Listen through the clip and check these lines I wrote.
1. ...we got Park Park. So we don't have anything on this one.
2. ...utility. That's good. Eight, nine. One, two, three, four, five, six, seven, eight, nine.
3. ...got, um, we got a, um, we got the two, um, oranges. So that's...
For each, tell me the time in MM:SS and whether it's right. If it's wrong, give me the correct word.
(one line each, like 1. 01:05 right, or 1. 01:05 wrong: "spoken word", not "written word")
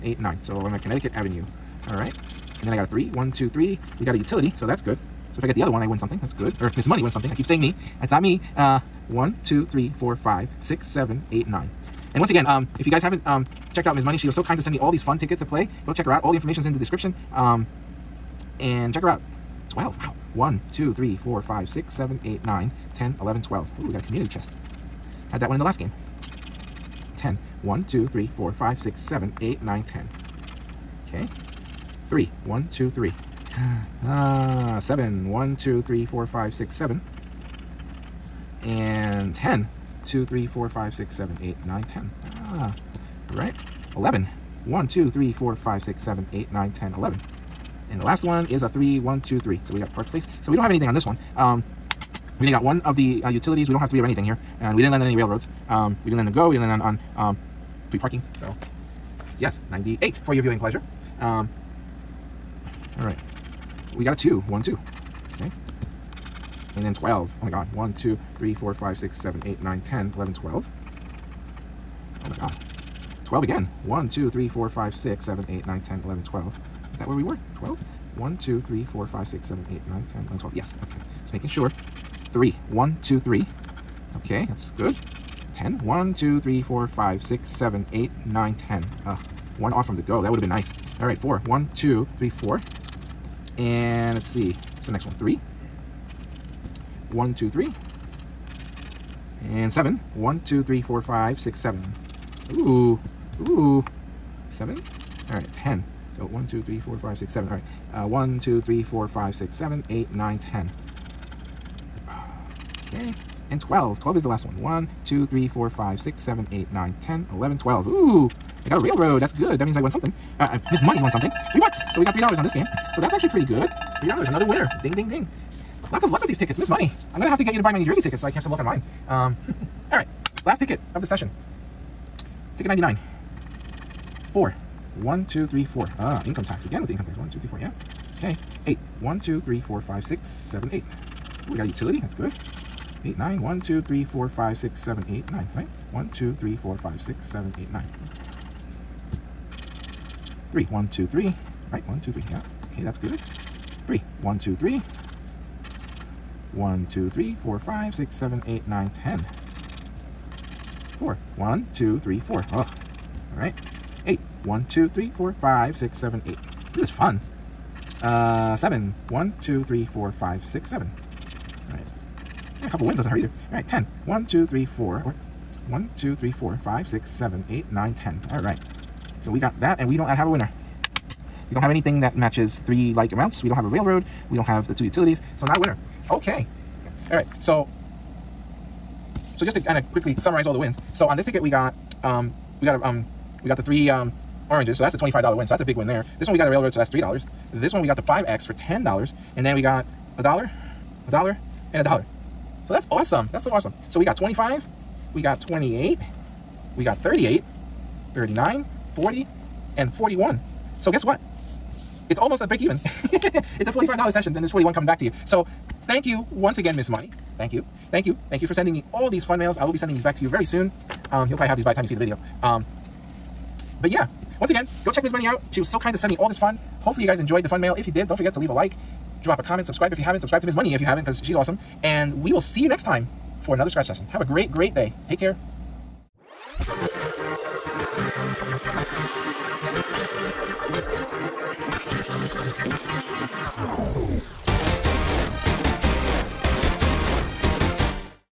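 1. 00:49 wrong: "Place", not "Park"
2. 02:21 right
3. 03:11 wrong: "three", not "two".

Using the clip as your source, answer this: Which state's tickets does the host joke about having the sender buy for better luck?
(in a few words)
New Jersey.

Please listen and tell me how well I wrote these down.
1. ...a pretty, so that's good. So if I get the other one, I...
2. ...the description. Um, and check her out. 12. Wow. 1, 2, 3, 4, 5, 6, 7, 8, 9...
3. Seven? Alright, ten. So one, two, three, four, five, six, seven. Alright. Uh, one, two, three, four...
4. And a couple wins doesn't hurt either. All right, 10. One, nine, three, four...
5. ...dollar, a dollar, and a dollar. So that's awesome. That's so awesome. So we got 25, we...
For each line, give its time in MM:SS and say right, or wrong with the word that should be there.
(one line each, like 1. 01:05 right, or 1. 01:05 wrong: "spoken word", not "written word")
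1. 00:04 wrong: "utility", not "pretty"
2. 00:16 right
3. 01:44 right
4. 02:52 wrong: "two", not "nine"
5. 03:20 right.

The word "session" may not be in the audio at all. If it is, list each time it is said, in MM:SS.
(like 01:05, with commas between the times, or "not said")
02:11, 03:34, 03:53.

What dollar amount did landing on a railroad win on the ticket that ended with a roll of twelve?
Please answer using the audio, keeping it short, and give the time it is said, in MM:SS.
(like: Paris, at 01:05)
$3, at 02:01.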